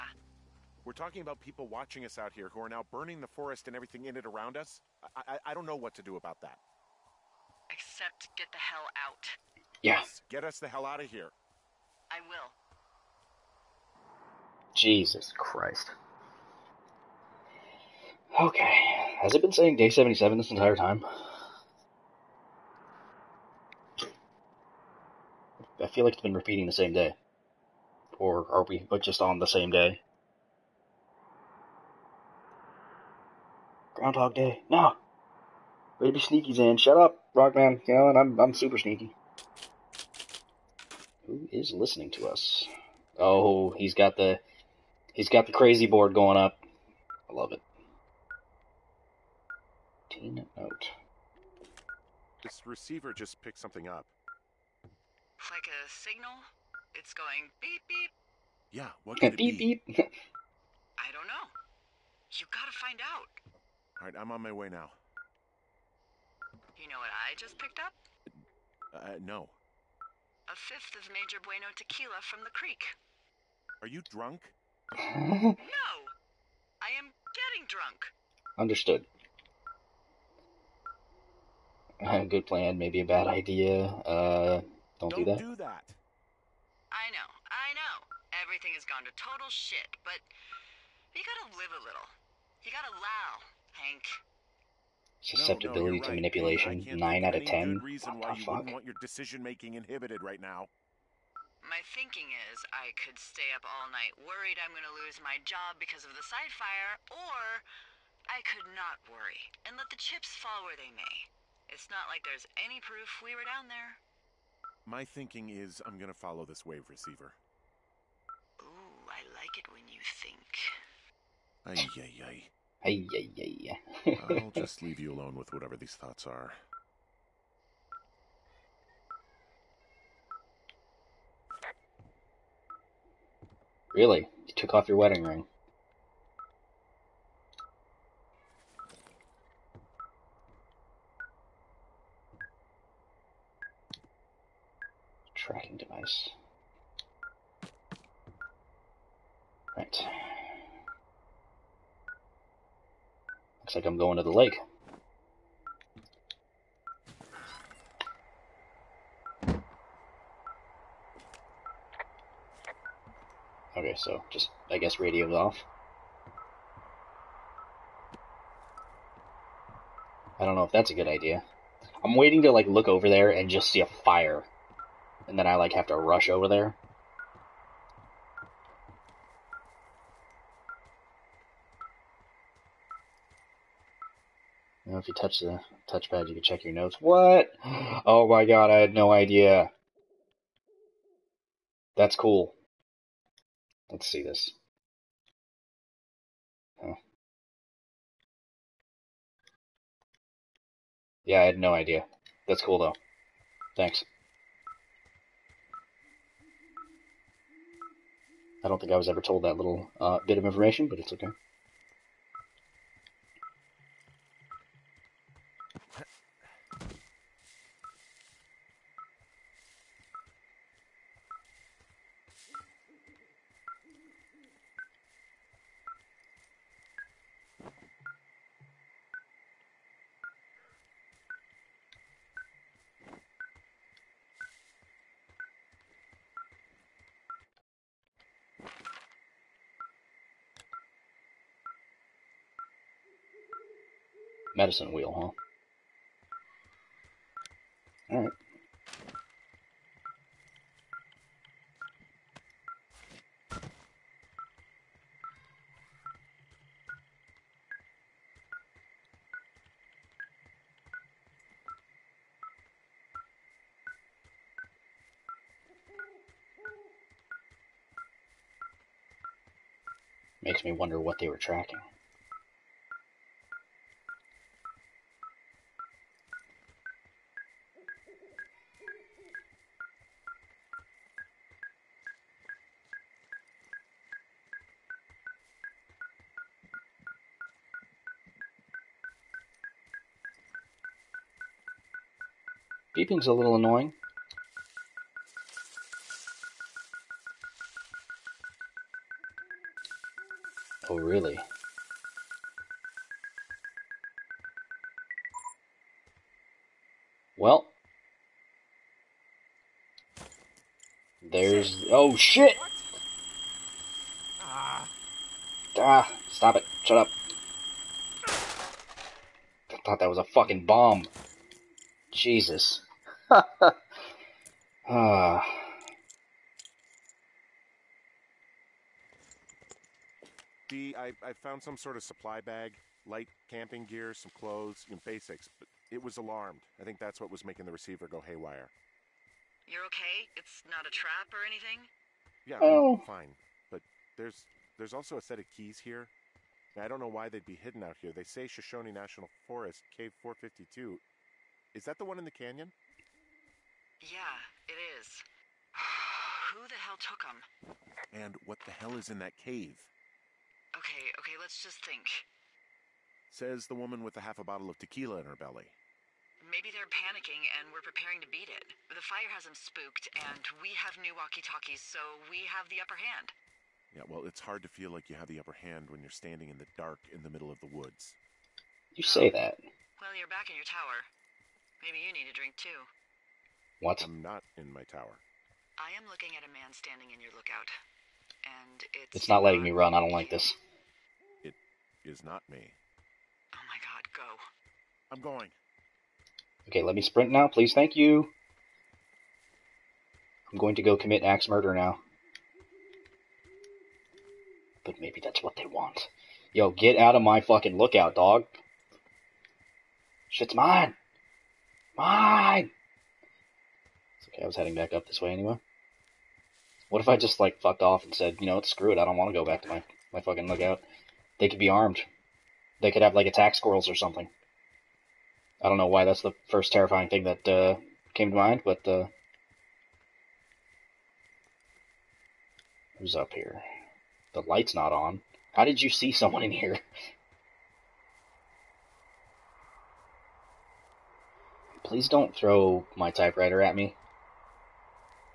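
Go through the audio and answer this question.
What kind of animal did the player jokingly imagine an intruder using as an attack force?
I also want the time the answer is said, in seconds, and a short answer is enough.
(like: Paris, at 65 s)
squirrels, at 423 s.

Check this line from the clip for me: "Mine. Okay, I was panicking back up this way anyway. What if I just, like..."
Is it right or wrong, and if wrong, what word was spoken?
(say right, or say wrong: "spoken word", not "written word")
wrong: "heading", not "panicking".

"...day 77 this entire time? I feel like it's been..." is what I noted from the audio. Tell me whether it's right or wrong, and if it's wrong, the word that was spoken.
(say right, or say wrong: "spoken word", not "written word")
right.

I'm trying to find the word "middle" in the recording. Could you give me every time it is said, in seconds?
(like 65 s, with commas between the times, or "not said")
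377 s.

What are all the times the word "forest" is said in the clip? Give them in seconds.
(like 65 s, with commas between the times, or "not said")
3 s, 349 s.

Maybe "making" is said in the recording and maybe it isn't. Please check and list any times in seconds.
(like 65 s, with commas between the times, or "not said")
99 s, 337 s.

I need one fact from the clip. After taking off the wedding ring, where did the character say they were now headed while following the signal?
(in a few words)
the lake.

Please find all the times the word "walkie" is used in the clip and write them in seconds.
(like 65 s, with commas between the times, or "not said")
371 s.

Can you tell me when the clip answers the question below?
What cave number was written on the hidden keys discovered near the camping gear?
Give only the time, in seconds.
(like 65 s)
349 s.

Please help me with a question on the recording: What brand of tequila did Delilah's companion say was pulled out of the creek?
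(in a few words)
Major Bueno.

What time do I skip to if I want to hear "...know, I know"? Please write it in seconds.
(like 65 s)
87 s.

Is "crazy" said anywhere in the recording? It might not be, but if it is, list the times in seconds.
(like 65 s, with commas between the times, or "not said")
45 s.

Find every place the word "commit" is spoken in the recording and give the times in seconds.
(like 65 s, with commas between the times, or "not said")
400 s.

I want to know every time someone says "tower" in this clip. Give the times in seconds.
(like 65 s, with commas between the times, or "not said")
380 s, 384 s.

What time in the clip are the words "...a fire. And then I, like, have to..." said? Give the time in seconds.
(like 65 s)
173 s.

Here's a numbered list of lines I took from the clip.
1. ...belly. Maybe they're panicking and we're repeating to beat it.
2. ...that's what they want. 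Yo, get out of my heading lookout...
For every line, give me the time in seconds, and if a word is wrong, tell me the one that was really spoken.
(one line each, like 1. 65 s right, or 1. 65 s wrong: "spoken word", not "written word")
1. 365 s wrong: "preparing", not "repeating"
2. 405 s wrong: "fucking", not "heading".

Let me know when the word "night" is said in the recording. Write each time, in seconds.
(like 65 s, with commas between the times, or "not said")
103 s.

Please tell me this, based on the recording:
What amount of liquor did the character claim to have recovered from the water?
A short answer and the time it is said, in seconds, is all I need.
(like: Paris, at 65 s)
A fifth, at 70 s.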